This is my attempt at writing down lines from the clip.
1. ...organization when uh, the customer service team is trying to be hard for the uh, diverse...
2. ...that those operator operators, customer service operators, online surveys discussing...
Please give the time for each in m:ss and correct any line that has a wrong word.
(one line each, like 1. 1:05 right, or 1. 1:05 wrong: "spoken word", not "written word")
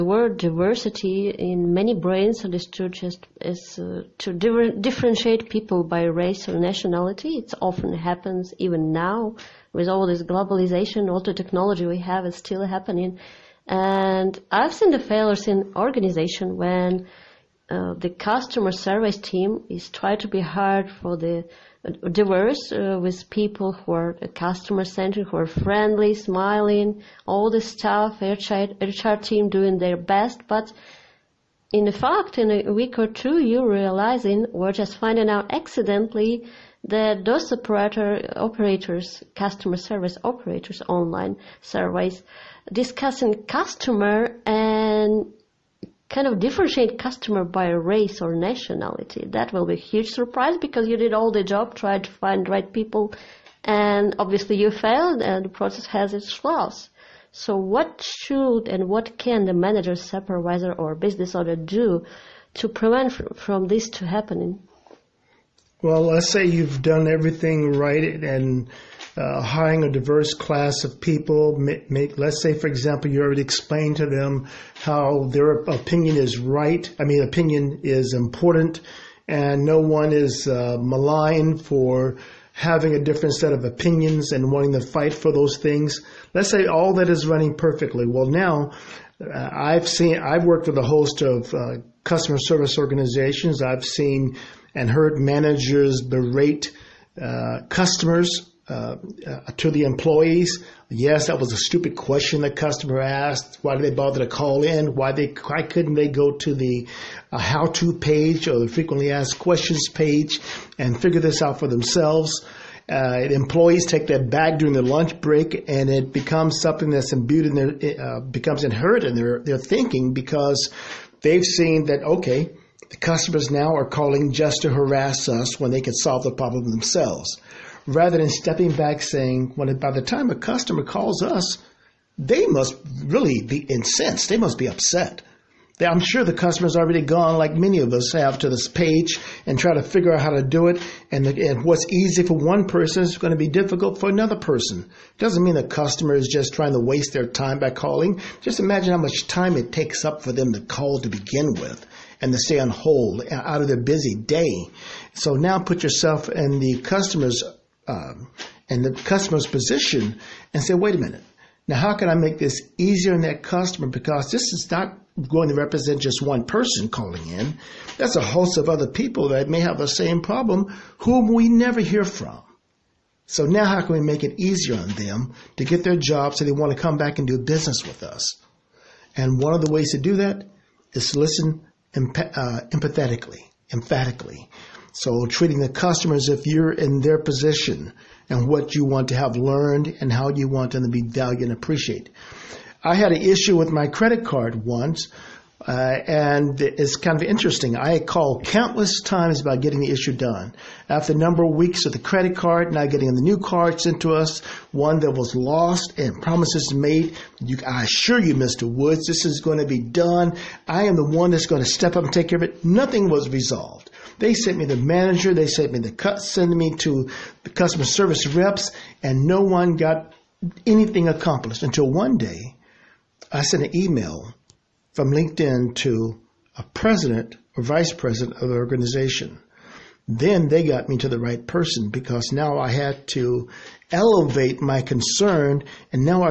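1. 0:15 right
2. 0:36 right.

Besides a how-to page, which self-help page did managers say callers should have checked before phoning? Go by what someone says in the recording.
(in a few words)
Frequently asked questions page.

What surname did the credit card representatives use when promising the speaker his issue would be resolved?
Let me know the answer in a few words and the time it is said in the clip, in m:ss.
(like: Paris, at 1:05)
Woods, at 3:28.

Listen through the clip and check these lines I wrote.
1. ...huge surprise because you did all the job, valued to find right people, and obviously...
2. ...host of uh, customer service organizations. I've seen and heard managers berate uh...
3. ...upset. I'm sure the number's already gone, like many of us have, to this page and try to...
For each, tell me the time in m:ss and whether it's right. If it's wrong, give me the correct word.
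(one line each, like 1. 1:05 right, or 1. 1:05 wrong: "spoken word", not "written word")
1. 0:49 wrong: "tried", not "valued"
2. 1:30 right
3. 2:14 wrong: "customer", not "number".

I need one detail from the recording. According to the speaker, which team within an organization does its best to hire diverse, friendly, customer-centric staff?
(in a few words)
HR team.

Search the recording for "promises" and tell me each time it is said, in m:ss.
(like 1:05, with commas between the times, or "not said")
3:26.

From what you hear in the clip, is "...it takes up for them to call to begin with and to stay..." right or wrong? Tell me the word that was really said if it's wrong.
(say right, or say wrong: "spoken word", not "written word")
right.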